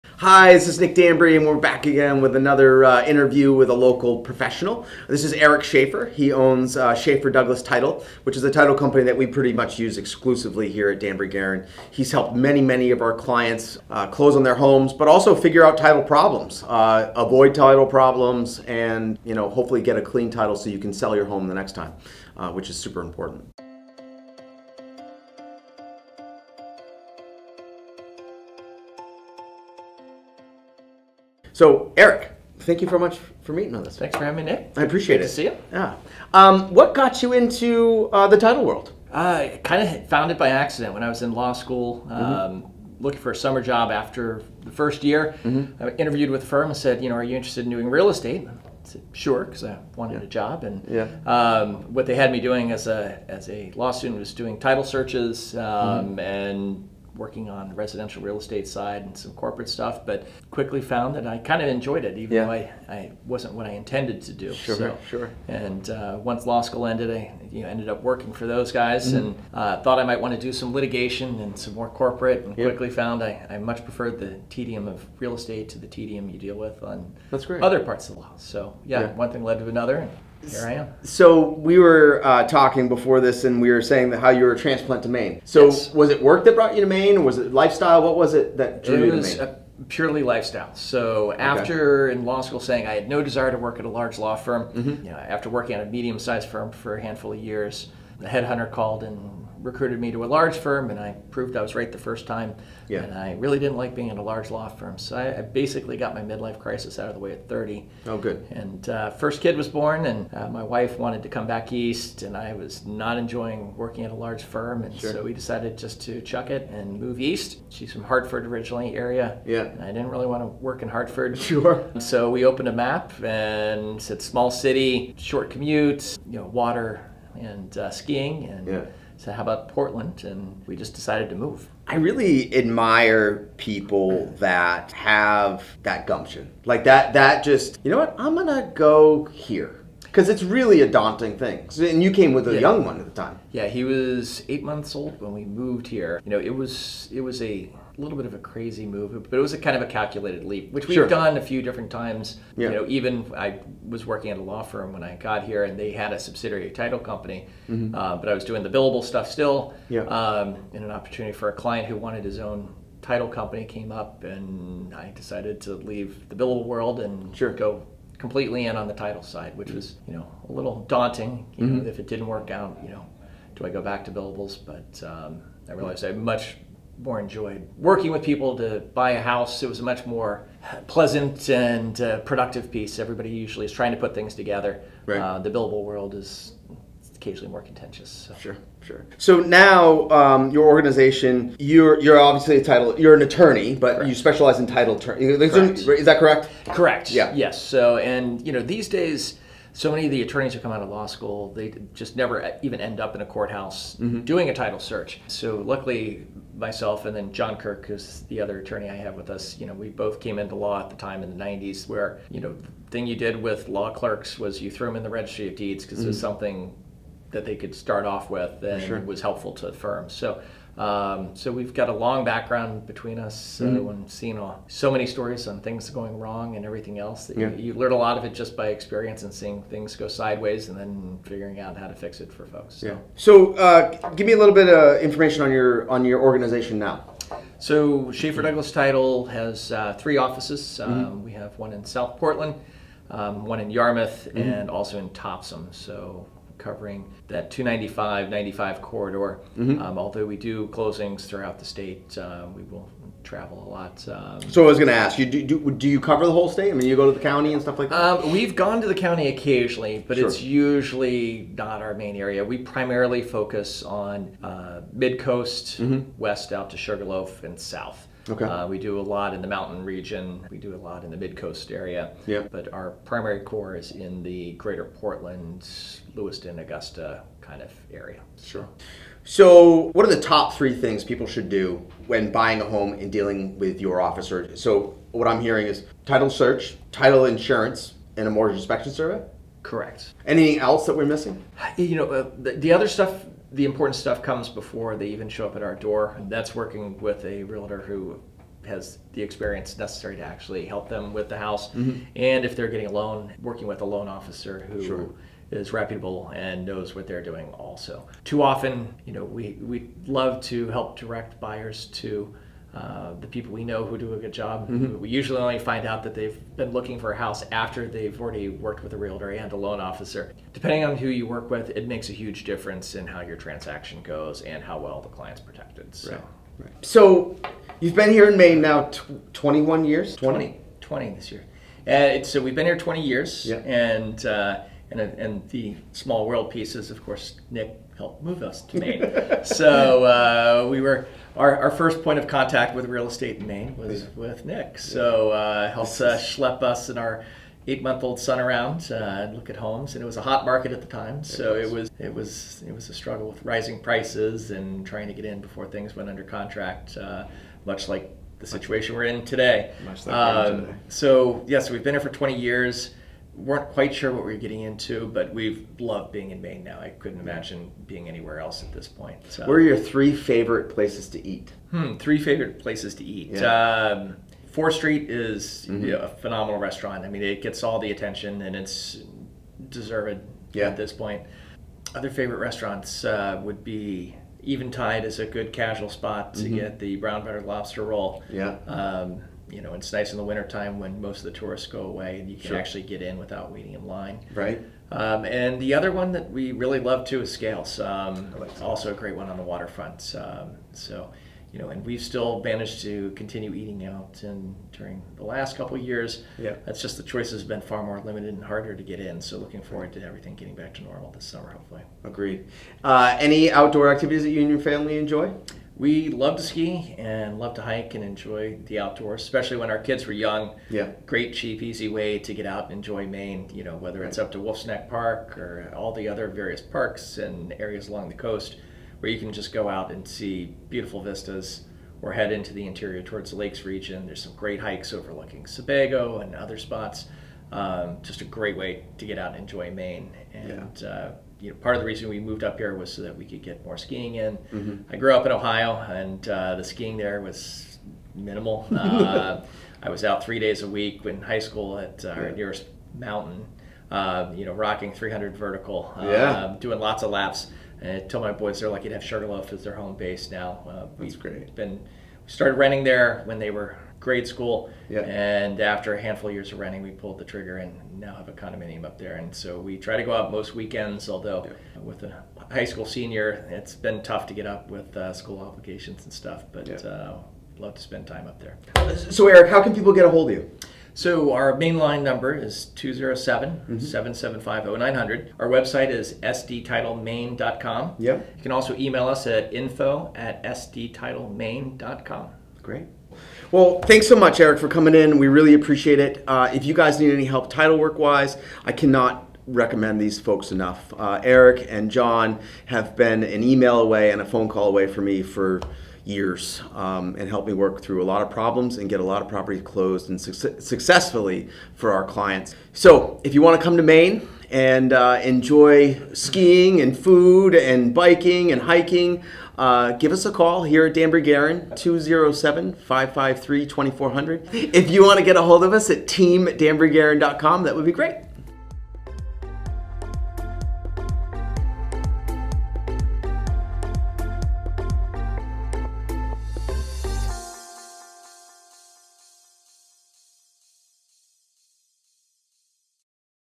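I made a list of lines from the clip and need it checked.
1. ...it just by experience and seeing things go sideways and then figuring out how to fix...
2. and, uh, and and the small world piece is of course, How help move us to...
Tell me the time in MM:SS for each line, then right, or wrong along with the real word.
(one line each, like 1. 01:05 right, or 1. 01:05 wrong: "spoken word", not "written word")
1. 03:48 right
2. 05:33 wrong: "Nick", not "How".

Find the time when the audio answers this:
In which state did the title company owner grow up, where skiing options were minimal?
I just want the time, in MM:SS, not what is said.
07:25.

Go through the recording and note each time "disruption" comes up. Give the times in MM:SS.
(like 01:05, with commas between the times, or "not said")
not said.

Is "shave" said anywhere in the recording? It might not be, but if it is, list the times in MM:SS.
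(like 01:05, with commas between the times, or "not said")
not said.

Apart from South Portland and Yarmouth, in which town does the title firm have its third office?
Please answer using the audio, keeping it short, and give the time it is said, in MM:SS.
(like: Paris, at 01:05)
Topsham, at 04:05.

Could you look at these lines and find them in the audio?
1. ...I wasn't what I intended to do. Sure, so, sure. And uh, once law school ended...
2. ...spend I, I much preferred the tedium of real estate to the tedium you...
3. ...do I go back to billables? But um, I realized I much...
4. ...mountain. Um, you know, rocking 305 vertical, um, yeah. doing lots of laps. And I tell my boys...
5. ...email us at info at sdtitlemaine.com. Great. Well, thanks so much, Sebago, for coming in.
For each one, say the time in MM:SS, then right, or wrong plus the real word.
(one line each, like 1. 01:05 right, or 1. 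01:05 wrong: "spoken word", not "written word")
1. 01:02 right
2. 01:12 wrong: "found", not "spend"
3. 02:53 right
4. 07:32 wrong: "300", not "305"
5. 08:08 wrong: "Eric", not "Sebago".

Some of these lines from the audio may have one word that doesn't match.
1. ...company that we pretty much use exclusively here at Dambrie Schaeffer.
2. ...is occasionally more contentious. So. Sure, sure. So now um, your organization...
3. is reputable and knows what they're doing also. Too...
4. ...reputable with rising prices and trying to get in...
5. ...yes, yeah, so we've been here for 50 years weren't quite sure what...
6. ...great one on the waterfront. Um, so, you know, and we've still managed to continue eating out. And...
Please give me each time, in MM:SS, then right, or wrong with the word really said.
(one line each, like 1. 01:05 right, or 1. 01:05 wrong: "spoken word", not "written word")
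1. 00:08 wrong: "Garon", not "Schaeffer"
2. 03:06 right
3. 05:05 right
4. 05:52 wrong: "struggle", not "reputable"
5. 06:01 wrong: "20", not "50"
6. 06:38 right.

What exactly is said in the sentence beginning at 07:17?
Um, just a great way to get out and enjoy Maine.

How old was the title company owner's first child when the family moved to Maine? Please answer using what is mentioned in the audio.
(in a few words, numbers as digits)
8 months.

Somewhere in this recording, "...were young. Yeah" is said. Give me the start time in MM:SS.
07:00.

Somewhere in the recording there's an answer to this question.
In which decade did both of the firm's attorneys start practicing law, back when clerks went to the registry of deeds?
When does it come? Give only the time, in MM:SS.
03:31.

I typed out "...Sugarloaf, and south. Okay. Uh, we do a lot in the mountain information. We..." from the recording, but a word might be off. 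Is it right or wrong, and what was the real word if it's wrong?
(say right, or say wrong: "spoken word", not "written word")
wrong: "region", not "information".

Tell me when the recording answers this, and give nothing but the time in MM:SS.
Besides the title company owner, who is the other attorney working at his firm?
03:27.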